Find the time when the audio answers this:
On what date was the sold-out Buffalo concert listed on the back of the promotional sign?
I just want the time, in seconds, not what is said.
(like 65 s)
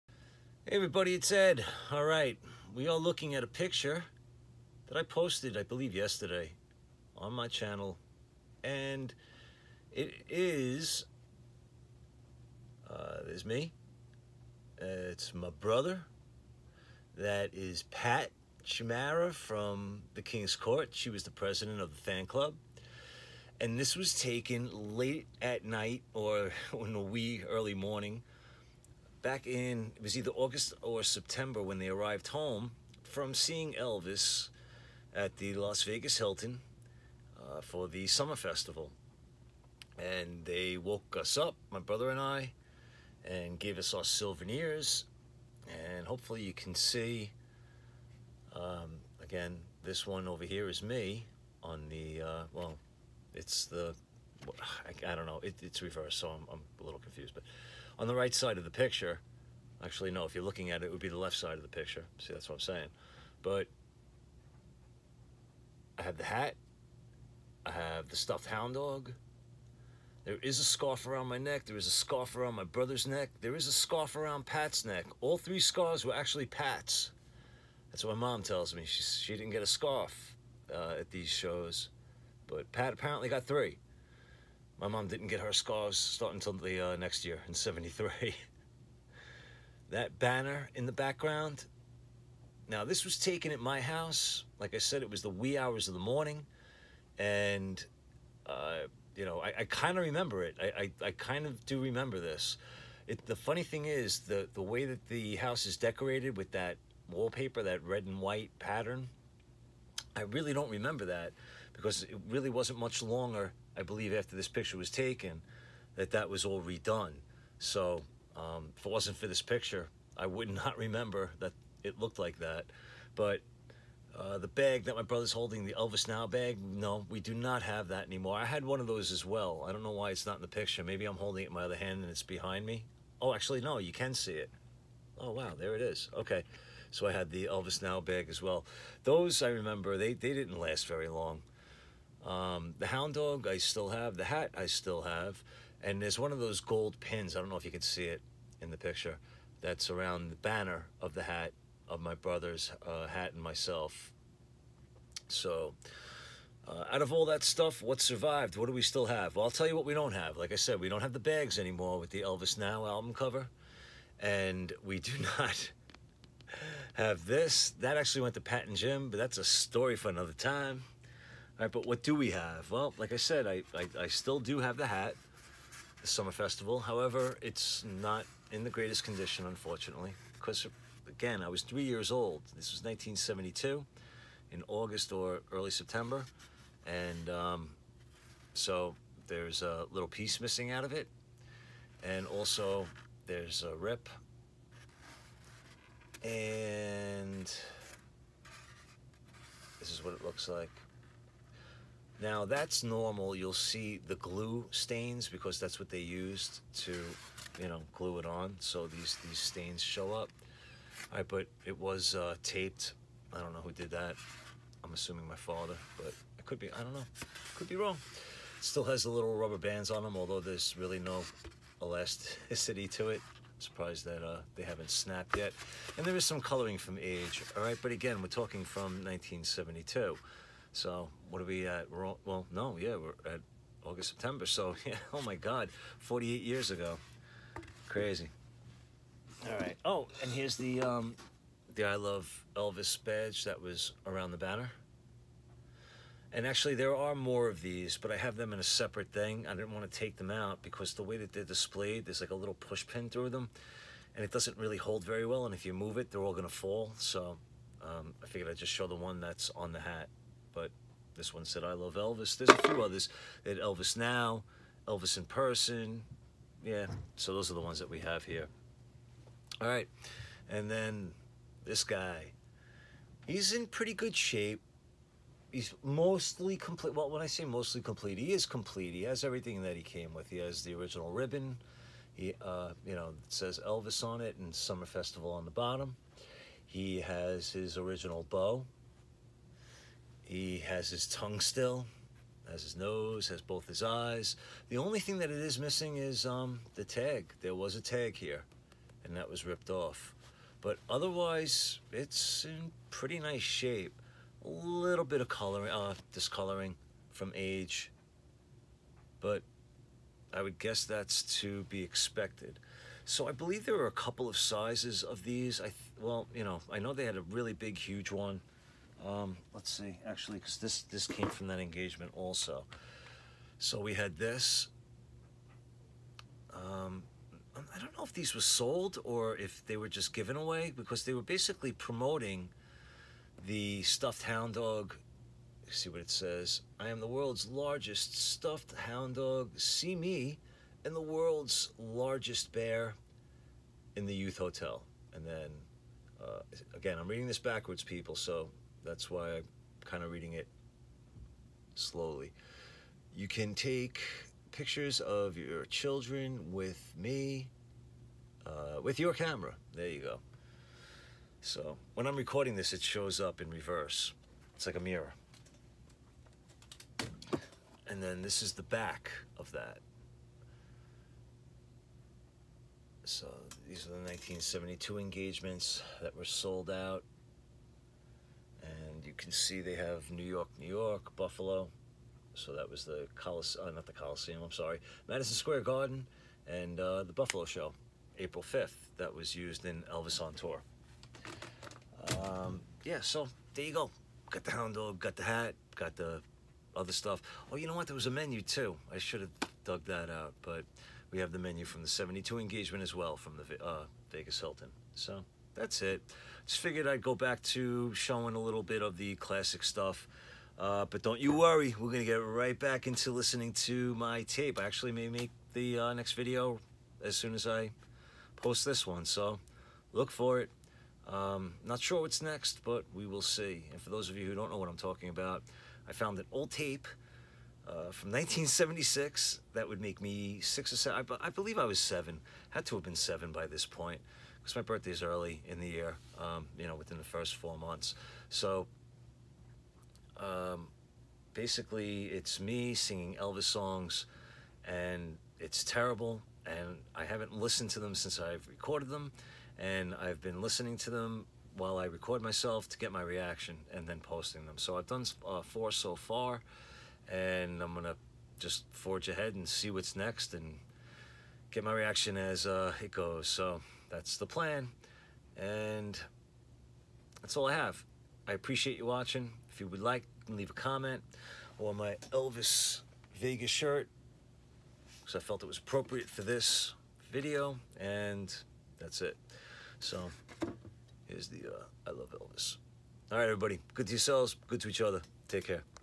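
388 s.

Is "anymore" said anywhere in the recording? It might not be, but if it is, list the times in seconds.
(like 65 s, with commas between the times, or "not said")
128 s, 161 s.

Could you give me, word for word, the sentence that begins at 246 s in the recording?
And actually, there are more of these, but I have them in a separate thing.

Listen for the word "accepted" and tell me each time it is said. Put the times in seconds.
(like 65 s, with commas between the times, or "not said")
not said.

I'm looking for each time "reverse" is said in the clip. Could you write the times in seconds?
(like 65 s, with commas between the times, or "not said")
55 s, 363 s.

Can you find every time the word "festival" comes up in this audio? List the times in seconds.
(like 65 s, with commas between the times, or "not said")
38 s, 176 s, 284 s.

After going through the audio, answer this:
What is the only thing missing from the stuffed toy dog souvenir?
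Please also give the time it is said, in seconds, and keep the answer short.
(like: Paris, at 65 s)
The tag, at 296 s.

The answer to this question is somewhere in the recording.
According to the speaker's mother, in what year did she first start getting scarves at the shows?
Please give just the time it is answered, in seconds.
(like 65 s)
87 s.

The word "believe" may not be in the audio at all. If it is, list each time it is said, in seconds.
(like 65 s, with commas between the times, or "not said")
5 s, 113 s, 313 s, 431 s.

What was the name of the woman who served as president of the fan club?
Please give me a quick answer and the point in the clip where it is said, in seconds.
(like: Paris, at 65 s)
Pat Chimara, at 17 s.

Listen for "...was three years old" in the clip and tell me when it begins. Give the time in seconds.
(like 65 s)
181 s.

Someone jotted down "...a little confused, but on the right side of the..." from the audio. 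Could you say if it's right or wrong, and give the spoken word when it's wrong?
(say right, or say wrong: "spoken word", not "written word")
right.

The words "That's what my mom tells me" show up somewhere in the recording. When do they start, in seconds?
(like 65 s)
77 s.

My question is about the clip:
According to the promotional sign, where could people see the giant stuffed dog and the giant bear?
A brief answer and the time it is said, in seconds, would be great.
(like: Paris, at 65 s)
The youth hotel, at 344 s.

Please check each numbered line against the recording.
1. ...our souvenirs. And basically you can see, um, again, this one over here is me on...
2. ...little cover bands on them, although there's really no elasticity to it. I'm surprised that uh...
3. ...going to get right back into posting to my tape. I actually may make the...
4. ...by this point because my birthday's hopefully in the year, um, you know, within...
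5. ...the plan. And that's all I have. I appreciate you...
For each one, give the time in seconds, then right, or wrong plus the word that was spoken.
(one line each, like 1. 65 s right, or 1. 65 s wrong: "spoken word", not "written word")
1. 43 s wrong: "hopefully", not "basically"
2. 219 s wrong: "rubber", not "cover"
3. 411 s wrong: "listening", not "posting"
4. 433 s wrong: "early", not "hopefully"
5. 464 s right.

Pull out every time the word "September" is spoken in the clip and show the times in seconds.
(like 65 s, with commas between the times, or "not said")
31 s, 185 s, 234 s.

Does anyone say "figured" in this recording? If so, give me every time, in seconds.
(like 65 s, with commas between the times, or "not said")
258 s, 406 s.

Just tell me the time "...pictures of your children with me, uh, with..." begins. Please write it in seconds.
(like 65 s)
354 s.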